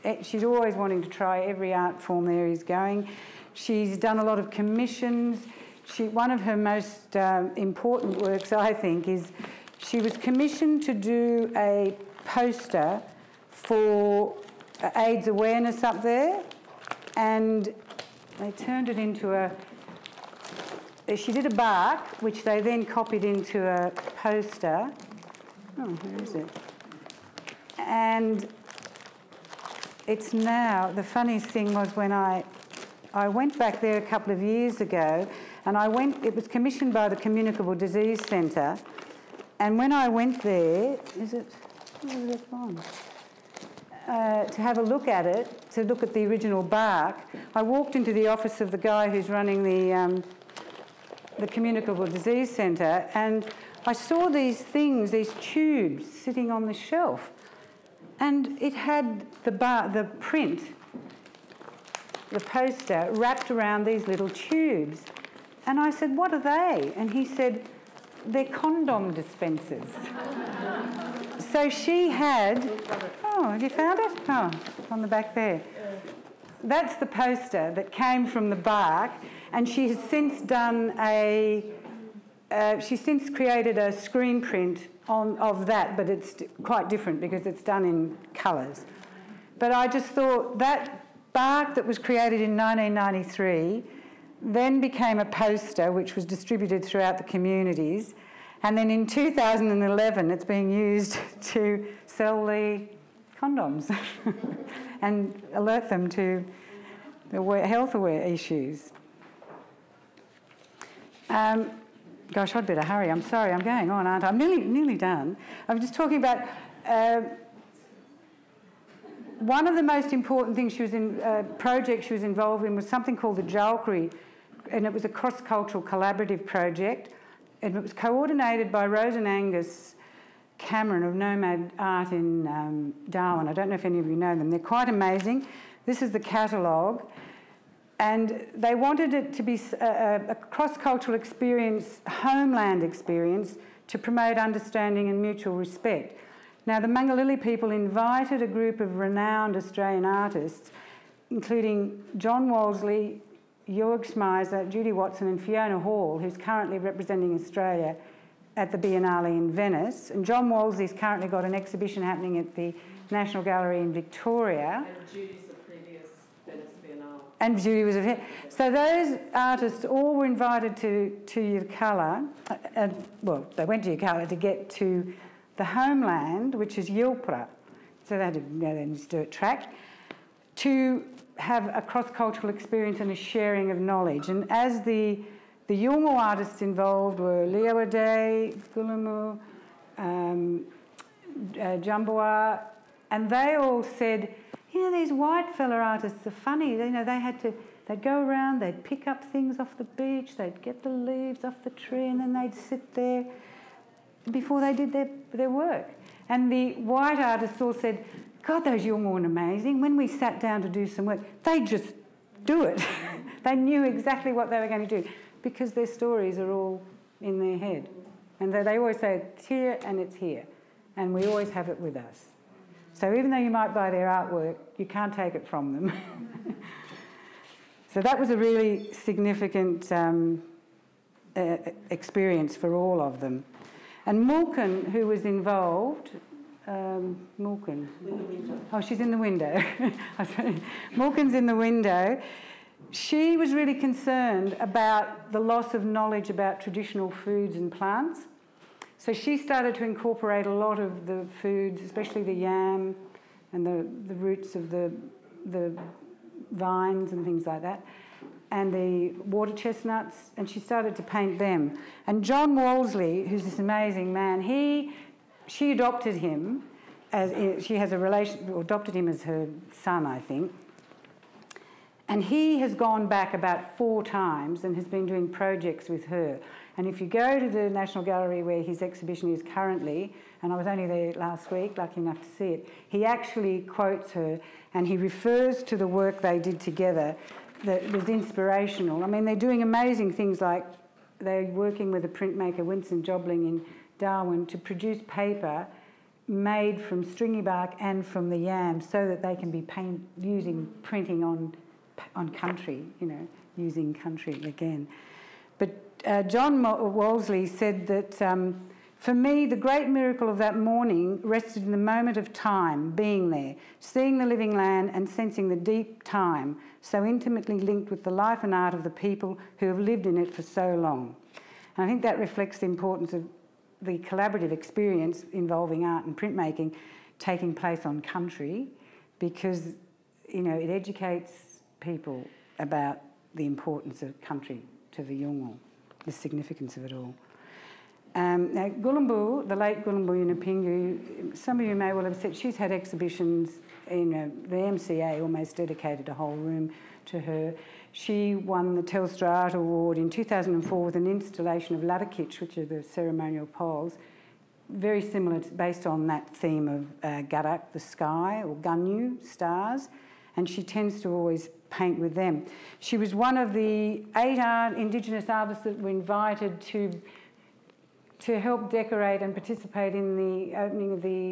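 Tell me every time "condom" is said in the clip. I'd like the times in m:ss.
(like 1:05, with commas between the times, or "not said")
1:08, 1:43.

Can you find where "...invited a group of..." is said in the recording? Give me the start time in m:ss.
2:27.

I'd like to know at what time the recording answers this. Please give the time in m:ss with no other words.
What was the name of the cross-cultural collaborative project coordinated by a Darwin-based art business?
2:03.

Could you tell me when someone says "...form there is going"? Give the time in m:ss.
0:02.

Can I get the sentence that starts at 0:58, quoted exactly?
And it had the, bar, the print, the poster, wrapped around these little tubes.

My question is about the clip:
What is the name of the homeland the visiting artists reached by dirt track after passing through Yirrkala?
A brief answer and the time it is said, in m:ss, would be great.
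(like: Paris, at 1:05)
Yilpara, at 2:56.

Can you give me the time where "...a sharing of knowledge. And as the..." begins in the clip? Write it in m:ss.
3:03.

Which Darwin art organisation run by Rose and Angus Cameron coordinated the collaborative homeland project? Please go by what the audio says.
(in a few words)
Nomad Art.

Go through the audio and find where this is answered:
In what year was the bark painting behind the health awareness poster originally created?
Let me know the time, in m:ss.
1:32.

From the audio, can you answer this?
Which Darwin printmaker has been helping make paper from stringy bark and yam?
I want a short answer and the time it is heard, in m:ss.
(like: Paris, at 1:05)
Winsome Jobling, at 4:52.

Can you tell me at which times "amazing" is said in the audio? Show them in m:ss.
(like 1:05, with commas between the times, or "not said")
2:14, 3:29, 4:23, 4:49.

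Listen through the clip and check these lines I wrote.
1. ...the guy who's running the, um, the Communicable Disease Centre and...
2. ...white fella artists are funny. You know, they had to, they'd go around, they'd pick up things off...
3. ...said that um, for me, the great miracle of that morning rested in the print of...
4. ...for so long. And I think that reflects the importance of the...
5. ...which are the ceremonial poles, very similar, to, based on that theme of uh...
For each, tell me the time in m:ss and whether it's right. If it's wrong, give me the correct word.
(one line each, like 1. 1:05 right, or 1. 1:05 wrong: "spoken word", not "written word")
1. 0:48 right
2. 3:15 right
3. 5:07 wrong: "moment", not "print"
4. 5:20 right
5. 5:52 right.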